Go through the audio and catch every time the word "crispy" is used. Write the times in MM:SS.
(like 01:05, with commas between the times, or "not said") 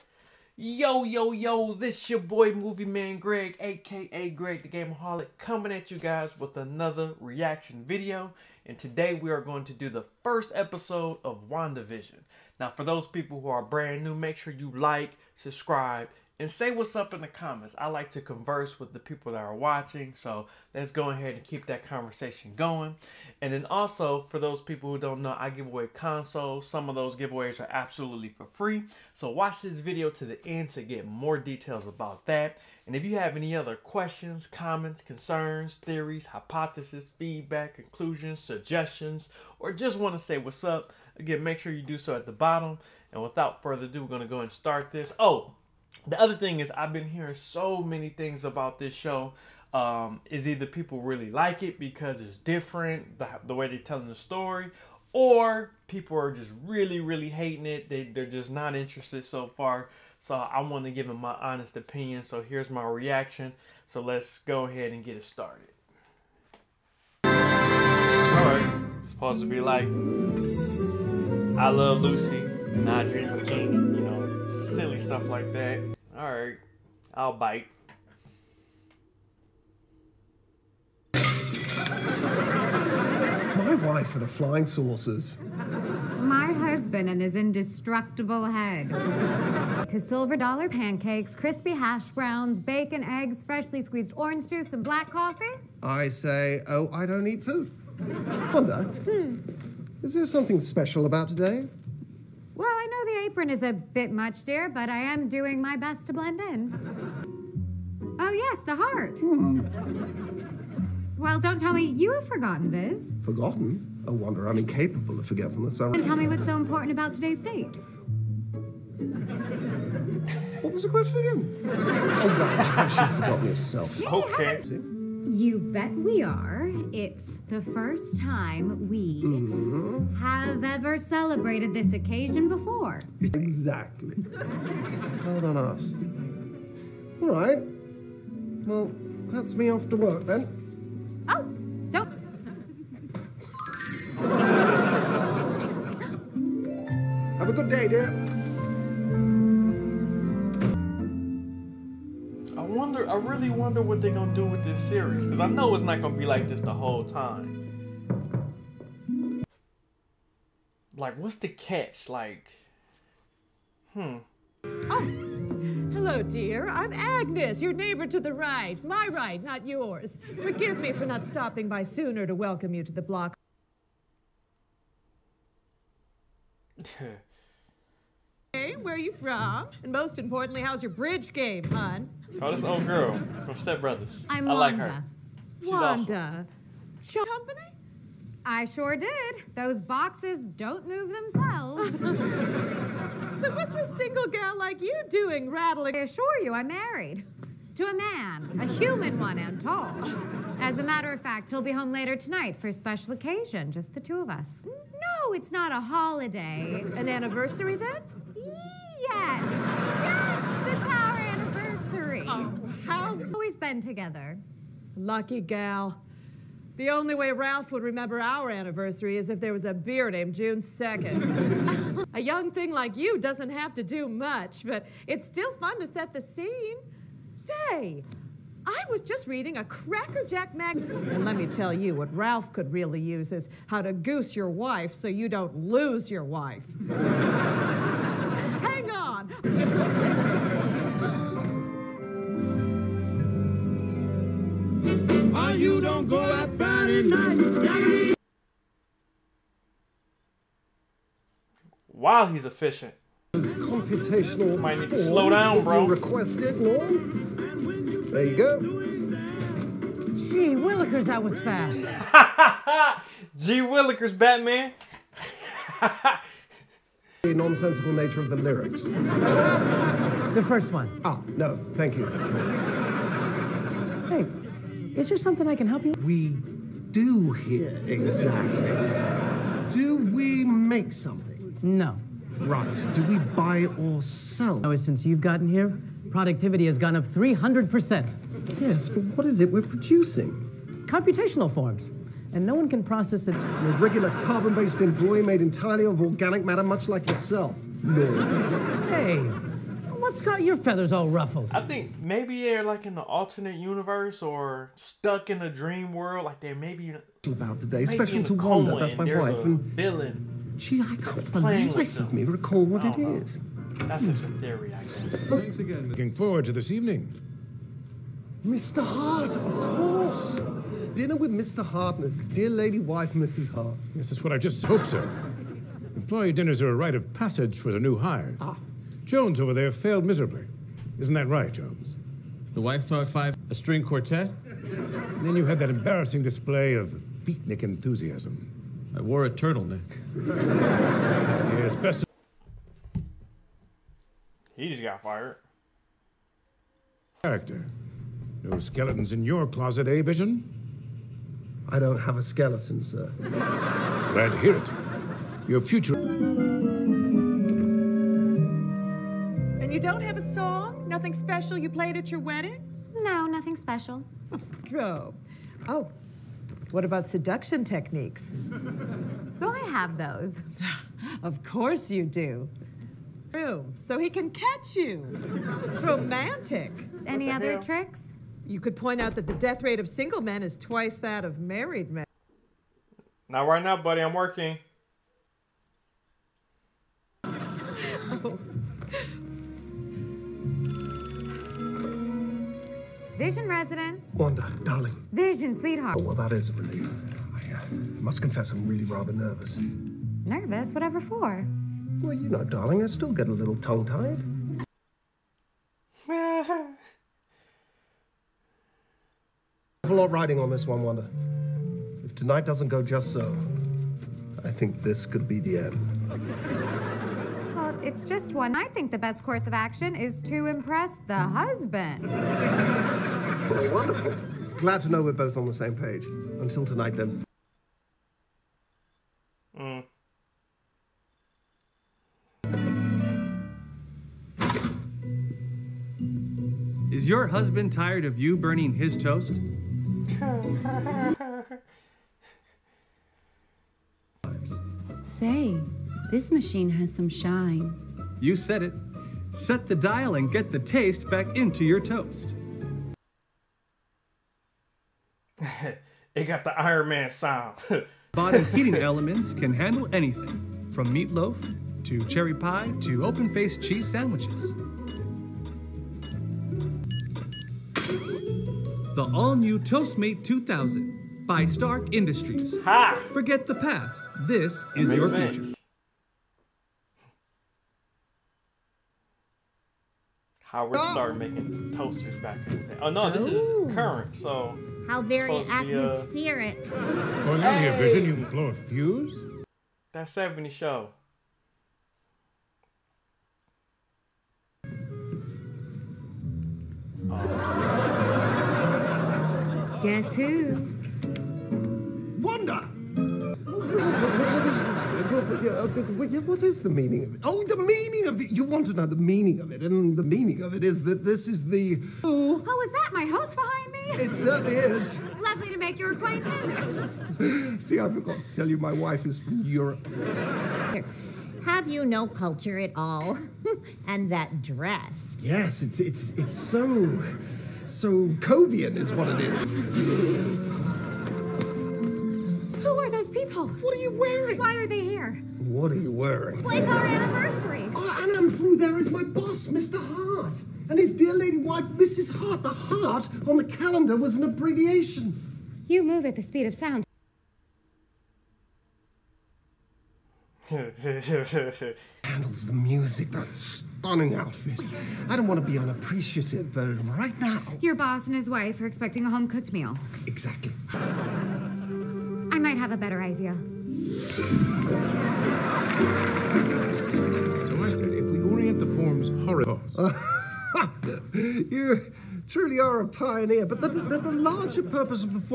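01:31.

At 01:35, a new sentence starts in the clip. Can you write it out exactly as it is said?
I say, oh, I don't eat food.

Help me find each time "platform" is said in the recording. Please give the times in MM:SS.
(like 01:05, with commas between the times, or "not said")
not said.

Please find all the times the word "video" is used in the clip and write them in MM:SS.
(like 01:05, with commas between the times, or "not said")
00:07, 00:29.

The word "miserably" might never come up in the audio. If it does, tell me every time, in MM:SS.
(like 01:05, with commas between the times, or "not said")
05:30.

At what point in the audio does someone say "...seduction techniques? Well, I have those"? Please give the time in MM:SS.
06:07.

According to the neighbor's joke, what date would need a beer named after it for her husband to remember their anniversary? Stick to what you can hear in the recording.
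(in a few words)
June 2nd.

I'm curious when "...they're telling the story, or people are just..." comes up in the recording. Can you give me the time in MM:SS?
00:53.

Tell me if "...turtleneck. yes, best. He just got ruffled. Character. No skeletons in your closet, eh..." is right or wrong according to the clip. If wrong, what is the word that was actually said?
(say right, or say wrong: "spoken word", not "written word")
wrong: "fired", not "ruffled".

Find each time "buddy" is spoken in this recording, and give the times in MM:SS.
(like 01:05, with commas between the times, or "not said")
06:23.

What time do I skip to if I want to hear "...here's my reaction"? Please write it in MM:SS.
01:02.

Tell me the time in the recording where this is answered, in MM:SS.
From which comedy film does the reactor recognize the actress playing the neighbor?
03:03.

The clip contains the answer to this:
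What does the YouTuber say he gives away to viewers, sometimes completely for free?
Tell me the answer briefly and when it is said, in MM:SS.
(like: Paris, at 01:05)
Consoles, at 00:25.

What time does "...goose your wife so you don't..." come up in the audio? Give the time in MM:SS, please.
03:53.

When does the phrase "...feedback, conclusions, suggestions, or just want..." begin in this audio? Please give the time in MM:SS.
00:37.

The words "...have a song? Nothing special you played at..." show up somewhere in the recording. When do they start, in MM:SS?
05:59.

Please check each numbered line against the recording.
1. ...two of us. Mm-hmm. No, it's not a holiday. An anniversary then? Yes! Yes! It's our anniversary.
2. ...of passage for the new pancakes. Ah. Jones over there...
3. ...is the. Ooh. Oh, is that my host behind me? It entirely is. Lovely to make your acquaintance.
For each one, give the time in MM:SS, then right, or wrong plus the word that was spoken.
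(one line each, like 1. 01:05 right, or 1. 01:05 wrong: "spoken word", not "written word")
1. 03:23 right
2. 05:26 wrong: "hires", not "pancakes"
3. 08:31 wrong: "certainly", not "entirely".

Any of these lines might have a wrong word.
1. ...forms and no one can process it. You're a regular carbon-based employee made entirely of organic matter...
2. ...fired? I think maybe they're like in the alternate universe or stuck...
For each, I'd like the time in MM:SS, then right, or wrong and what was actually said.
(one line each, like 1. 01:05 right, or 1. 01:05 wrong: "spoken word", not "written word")
1. 04:51 right
2. 05:01 wrong: "ruffled", not "fired".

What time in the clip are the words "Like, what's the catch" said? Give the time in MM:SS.
02:40.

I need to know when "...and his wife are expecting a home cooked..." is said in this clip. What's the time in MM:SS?
09:18.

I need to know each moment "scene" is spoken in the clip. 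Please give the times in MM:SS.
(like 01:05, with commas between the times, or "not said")
03:46.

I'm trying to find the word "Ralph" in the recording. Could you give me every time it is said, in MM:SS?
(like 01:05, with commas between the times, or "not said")
03:37, 03:52.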